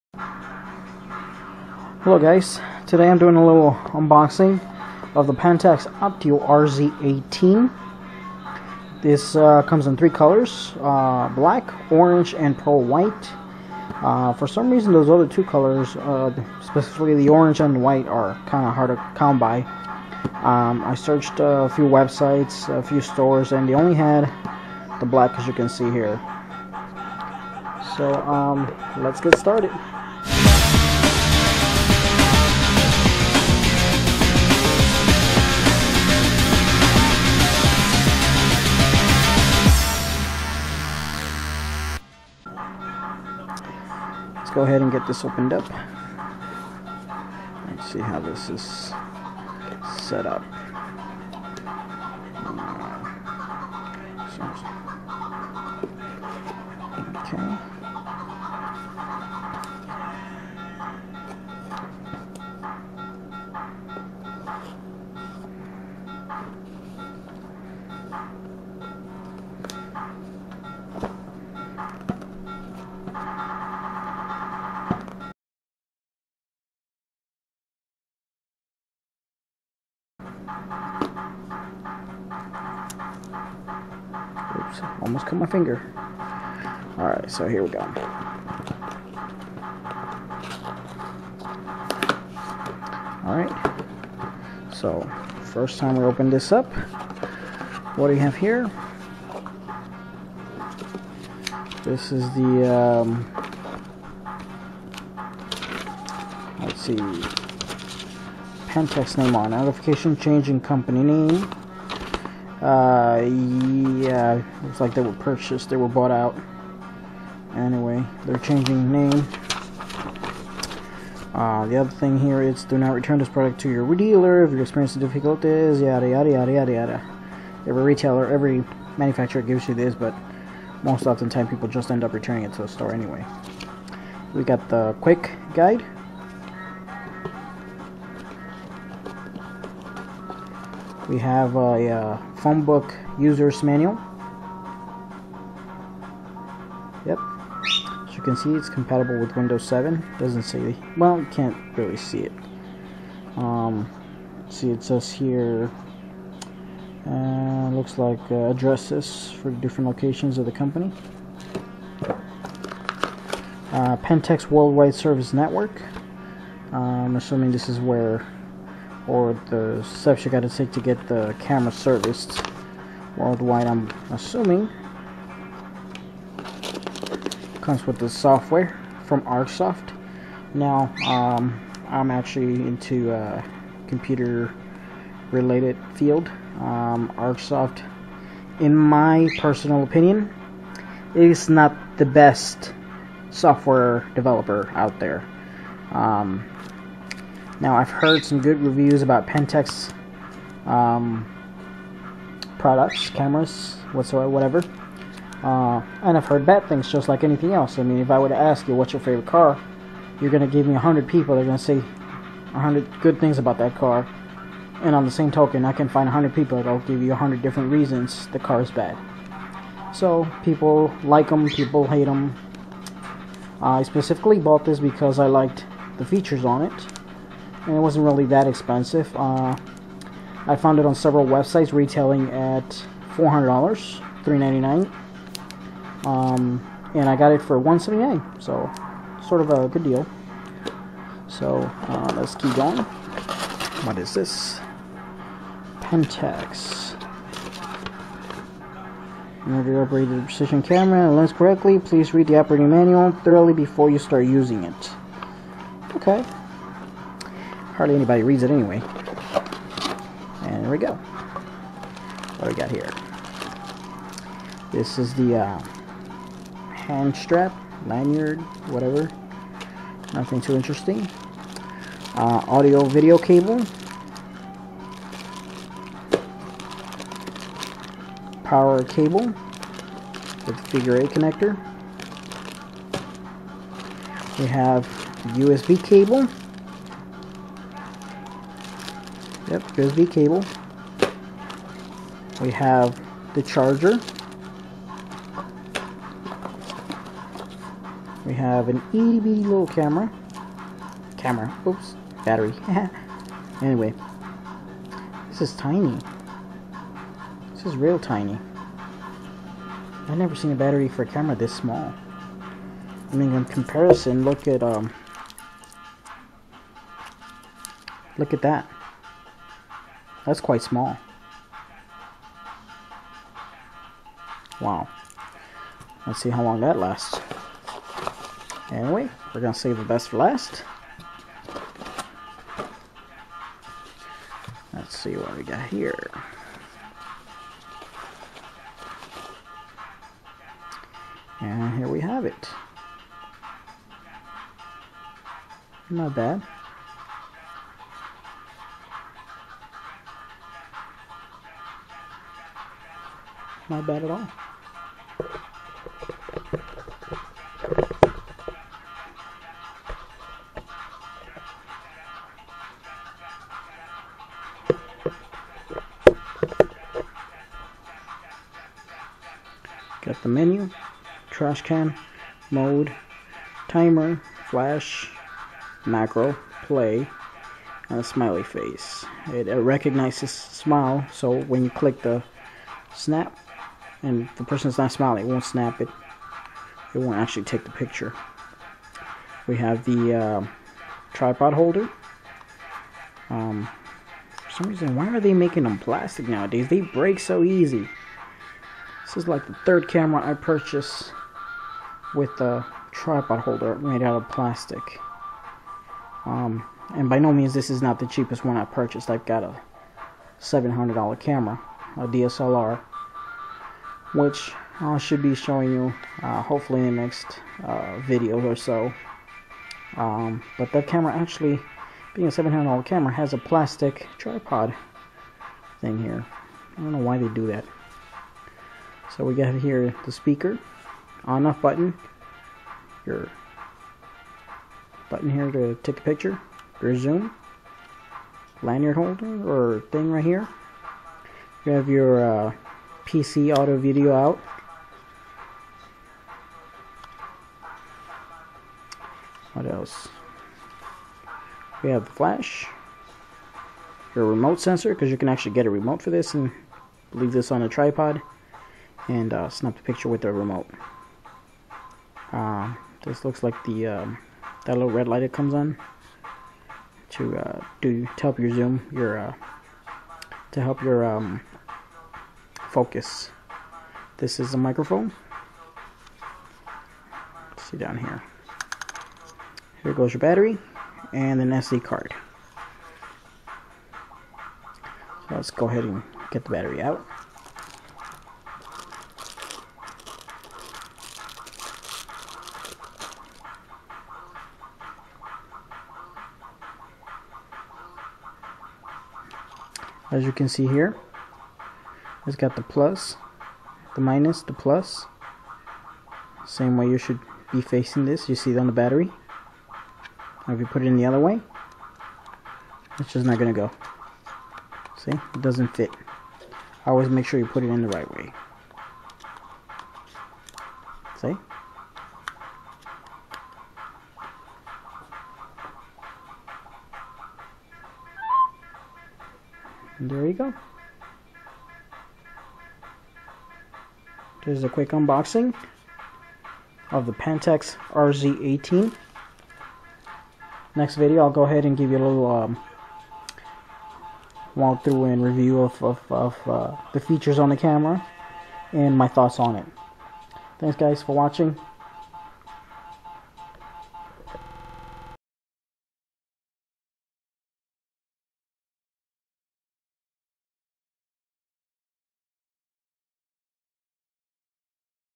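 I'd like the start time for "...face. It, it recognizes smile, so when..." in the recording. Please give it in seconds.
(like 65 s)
378 s.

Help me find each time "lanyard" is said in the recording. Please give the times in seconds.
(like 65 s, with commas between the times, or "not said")
267 s, 438 s.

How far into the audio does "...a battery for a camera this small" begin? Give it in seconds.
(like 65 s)
310 s.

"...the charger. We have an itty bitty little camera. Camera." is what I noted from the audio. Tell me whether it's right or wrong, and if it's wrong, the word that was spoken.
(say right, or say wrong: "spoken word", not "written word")
right.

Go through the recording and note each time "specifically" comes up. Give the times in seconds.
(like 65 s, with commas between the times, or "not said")
16 s, 223 s.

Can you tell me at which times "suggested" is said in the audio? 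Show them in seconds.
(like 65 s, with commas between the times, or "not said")
not said.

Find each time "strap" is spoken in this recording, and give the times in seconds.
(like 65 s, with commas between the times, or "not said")
267 s.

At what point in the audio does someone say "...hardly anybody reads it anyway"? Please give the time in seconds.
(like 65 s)
257 s.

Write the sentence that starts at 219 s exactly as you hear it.
So, people like them, people hate them.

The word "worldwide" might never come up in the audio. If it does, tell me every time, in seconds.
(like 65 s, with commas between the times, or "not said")
164 s, 173 s.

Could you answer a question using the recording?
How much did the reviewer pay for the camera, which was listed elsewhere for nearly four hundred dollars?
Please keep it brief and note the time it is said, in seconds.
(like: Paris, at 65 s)
$178, at 237 s.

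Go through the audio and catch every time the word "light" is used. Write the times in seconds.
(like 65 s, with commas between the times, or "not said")
465 s.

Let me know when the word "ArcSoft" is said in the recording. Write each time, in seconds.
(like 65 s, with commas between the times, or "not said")
179 s, 187 s.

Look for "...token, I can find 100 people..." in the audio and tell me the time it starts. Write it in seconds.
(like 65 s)
215 s.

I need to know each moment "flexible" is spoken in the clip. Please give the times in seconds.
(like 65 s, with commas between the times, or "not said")
not said.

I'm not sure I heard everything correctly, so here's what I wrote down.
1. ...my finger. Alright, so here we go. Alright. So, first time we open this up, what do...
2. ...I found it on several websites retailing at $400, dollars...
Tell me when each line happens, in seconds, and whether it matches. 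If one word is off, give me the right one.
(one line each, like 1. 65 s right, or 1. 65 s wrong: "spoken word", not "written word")
1. 85 s right
2. 230 s right.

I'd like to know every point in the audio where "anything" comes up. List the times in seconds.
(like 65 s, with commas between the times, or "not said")
207 s.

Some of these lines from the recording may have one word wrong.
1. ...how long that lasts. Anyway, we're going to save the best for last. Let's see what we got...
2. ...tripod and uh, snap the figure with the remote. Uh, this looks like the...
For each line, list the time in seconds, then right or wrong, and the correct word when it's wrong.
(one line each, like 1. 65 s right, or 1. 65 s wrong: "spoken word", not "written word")
1. 326 s right
2. 457 s wrong: "picture", not "figure".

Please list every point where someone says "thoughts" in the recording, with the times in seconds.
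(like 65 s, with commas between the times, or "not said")
549 s.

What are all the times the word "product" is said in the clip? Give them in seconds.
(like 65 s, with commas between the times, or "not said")
123 s, 202 s.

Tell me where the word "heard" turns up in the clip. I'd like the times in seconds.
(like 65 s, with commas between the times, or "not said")
197 s, 206 s.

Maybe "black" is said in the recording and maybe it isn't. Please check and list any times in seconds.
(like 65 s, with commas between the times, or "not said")
11 s, 25 s.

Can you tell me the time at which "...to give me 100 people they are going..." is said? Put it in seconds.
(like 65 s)
210 s.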